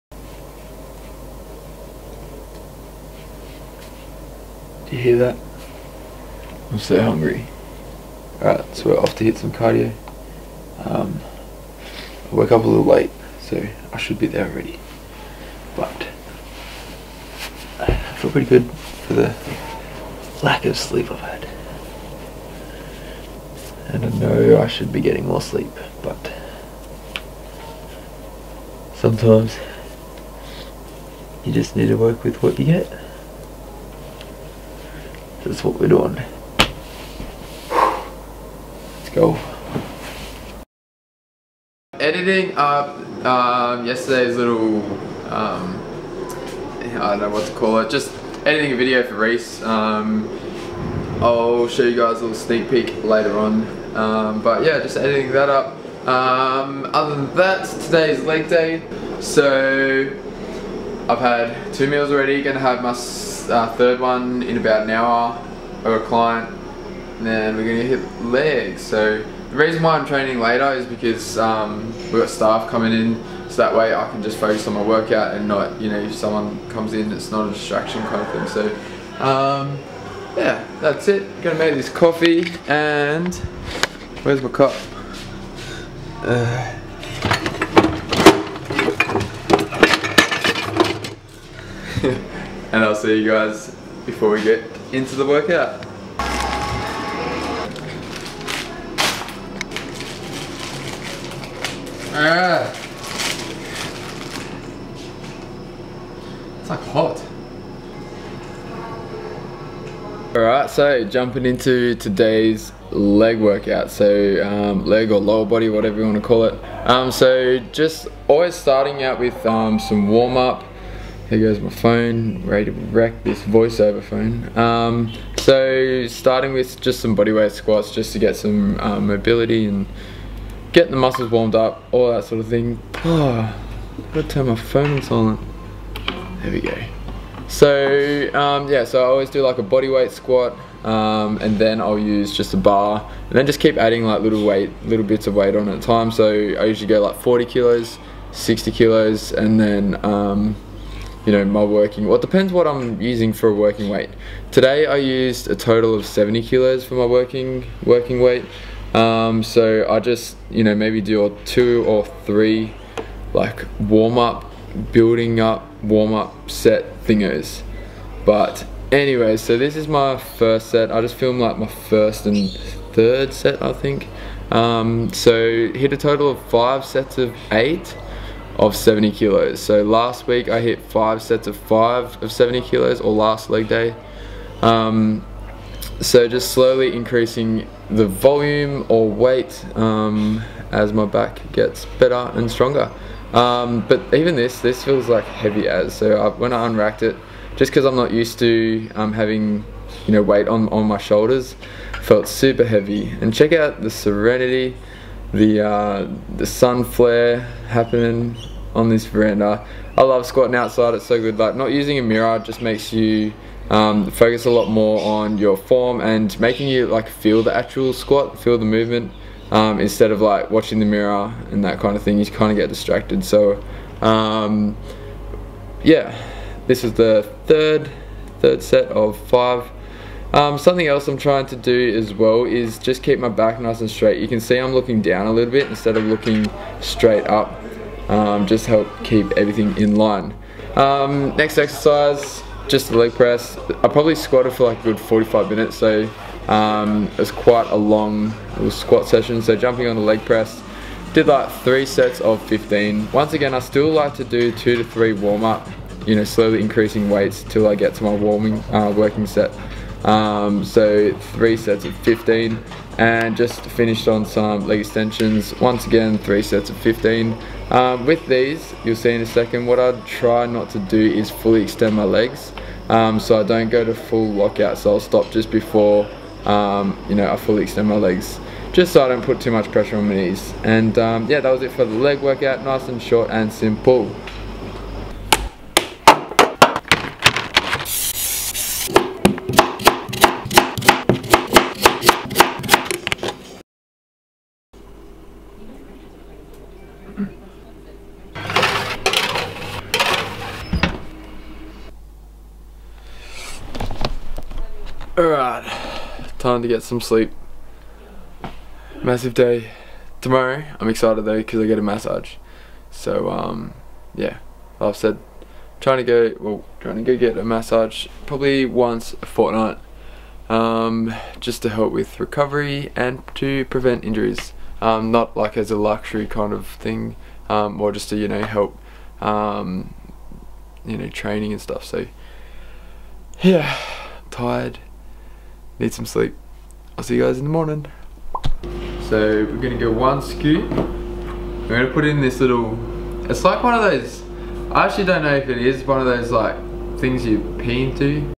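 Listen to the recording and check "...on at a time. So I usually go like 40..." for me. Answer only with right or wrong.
right.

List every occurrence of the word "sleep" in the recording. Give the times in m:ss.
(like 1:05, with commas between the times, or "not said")
0:20, 0:25, 5:06, 5:36.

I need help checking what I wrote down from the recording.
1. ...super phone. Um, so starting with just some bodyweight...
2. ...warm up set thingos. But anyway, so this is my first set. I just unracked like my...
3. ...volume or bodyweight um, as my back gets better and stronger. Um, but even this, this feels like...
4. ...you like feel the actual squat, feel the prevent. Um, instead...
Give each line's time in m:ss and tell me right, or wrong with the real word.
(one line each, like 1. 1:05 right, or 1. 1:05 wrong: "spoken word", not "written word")
1. 2:03 wrong: "voiceover", not "super"
2. 2:45 wrong: "filmed", not "unracked"
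3. 3:08 wrong: "weight", not "bodyweight"
4. 3:36 wrong: "movement", not "prevent".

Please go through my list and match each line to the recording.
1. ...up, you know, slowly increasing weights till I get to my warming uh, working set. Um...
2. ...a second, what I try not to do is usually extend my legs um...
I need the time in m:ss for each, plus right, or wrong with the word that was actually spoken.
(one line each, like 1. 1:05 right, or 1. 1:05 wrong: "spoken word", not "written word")
1. 4:15 right
2. 4:29 wrong: "fully", not "usually".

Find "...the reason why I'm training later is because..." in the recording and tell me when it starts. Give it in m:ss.
1:09.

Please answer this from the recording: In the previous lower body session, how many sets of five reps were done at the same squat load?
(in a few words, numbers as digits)
5.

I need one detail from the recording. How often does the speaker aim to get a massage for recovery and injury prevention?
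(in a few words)
Once a fortnight.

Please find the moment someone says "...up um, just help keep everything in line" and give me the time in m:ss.
3:57.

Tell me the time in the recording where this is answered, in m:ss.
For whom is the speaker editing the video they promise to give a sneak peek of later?
0:49.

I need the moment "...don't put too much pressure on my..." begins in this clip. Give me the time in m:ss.
4:39.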